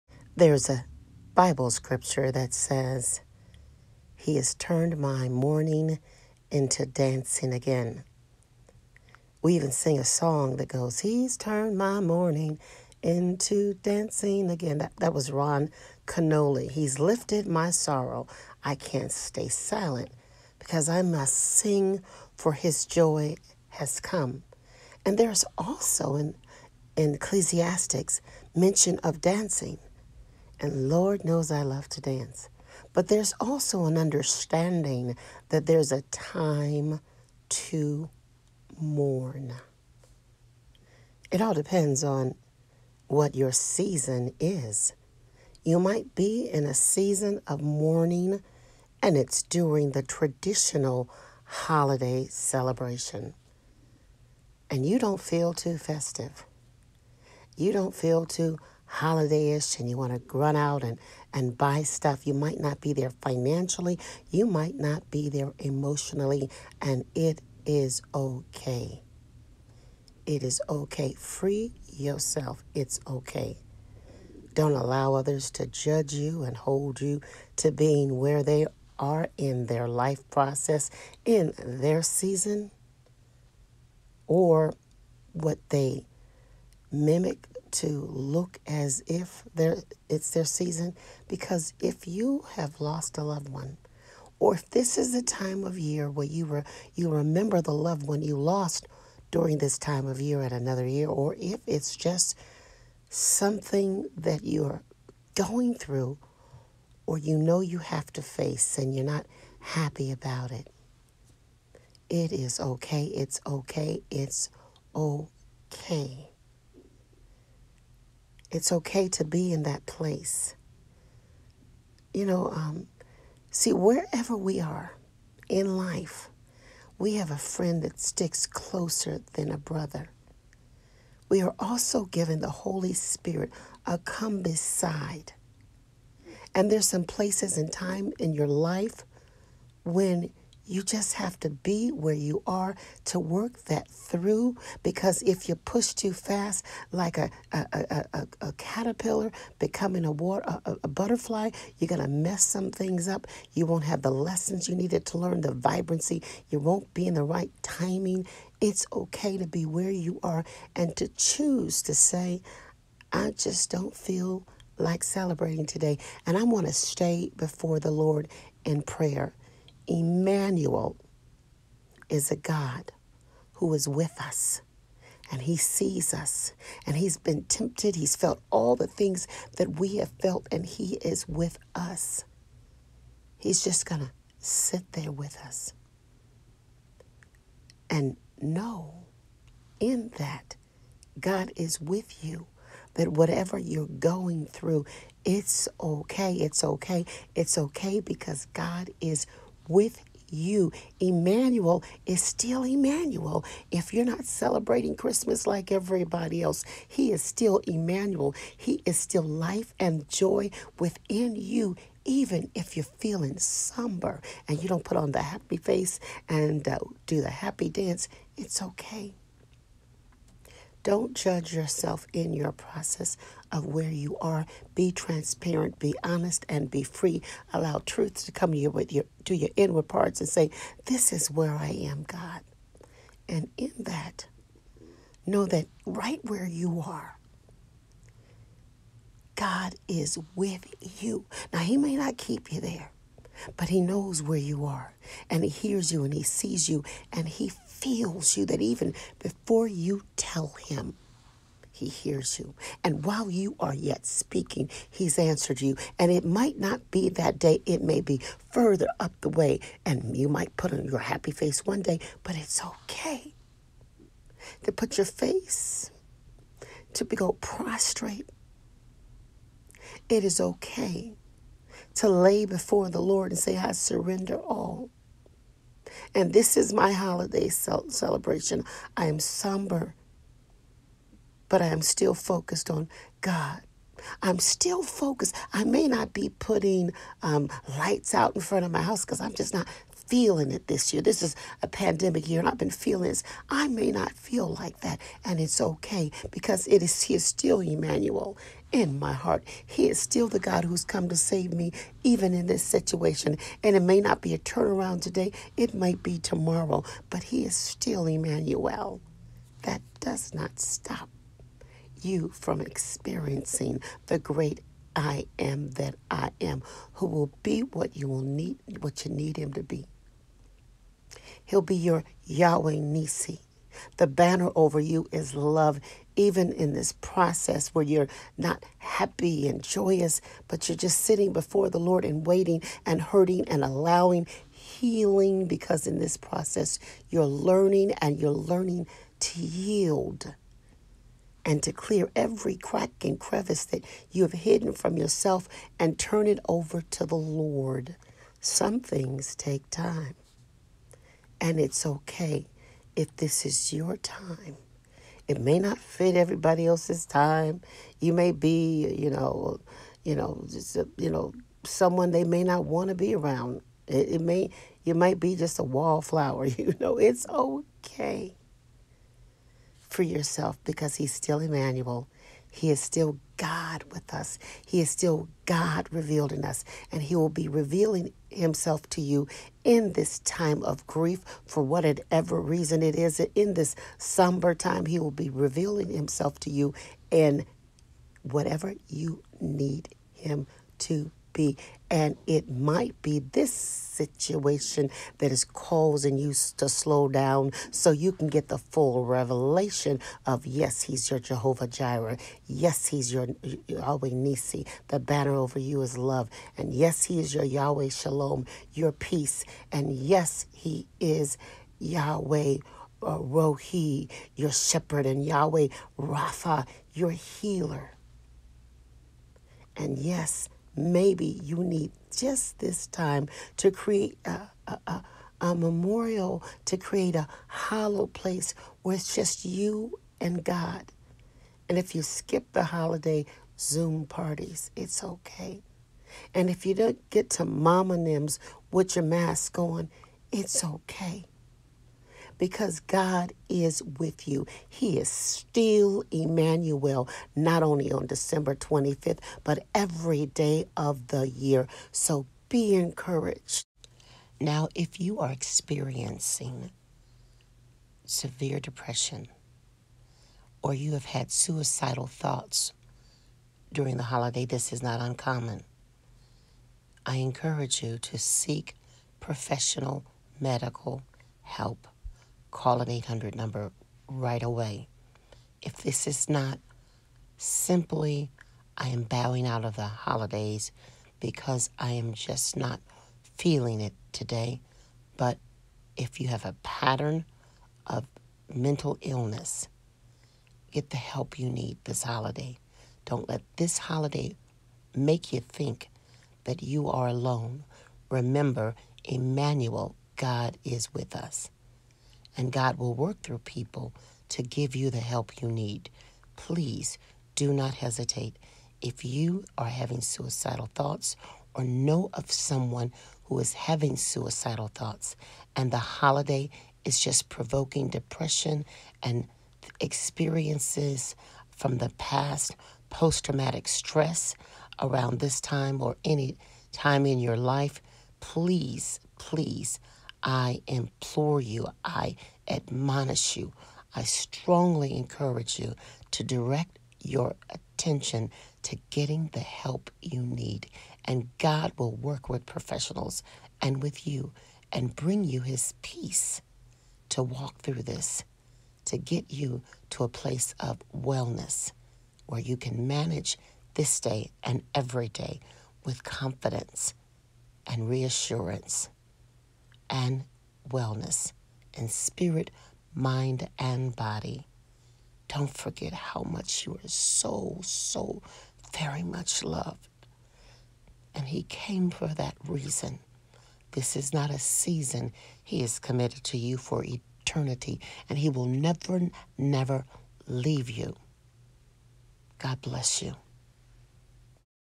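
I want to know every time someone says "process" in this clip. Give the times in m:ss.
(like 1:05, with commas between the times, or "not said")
1:20, 3:42, 5:26, 5:36.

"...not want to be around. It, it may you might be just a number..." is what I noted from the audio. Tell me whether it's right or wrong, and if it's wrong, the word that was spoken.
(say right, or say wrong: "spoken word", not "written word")
wrong: "wallflower", not "number".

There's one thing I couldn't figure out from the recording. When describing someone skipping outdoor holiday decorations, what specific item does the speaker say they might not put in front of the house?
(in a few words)
lights.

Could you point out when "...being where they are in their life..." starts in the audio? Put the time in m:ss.
1:17.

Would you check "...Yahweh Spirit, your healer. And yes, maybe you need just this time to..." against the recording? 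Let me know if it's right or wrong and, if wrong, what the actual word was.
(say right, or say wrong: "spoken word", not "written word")
wrong: "Rapha", not "Spirit".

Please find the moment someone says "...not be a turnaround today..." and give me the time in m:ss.
5:04.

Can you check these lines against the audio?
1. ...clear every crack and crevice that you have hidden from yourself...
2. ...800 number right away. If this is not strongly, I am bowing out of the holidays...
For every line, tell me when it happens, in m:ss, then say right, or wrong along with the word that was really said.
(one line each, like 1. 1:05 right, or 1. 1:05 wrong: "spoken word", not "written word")
1. 5:41 right
2. 7:52 wrong: "simply", not "strongly".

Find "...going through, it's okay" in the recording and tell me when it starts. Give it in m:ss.
3:13.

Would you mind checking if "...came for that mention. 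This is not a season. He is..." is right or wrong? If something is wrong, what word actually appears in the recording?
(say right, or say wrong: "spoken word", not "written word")
wrong: "reason", not "mention".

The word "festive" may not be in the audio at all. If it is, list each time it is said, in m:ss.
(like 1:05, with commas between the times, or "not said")
0:55.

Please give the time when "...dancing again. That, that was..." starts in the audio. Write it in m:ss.
0:13.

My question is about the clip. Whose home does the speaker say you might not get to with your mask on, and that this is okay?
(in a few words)
Mama Nims.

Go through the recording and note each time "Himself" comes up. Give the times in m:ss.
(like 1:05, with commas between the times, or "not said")
6:18, 6:25.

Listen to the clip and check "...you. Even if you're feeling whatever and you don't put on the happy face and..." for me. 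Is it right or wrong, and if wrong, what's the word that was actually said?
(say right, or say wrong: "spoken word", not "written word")
wrong: "somber", not "whatever".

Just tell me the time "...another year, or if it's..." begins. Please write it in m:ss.
1:40.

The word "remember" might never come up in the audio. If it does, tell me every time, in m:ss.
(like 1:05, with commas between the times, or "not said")
1:37, 8:18.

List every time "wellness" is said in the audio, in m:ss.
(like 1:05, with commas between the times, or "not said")
9:10, 9:20.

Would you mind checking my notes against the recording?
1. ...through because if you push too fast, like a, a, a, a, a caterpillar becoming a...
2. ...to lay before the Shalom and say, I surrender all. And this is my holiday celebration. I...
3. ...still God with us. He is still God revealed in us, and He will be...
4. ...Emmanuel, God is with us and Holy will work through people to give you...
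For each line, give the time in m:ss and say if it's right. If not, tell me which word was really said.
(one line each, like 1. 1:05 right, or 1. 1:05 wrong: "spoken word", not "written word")
1. 2:23 right
2. 4:31 wrong: "Lord", not "Shalom"
3. 6:12 right
4. 8:19 wrong: "God", not "Holy".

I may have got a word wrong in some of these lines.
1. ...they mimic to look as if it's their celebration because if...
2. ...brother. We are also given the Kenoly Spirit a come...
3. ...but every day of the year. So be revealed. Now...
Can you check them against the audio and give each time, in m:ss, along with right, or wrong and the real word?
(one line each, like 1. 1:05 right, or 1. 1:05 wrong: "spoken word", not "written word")
1. 1:25 wrong: "season", not "celebration"
2. 2:09 wrong: "Holy", not "Kenoly"
3. 7:29 wrong: "encouraged", not "revealed".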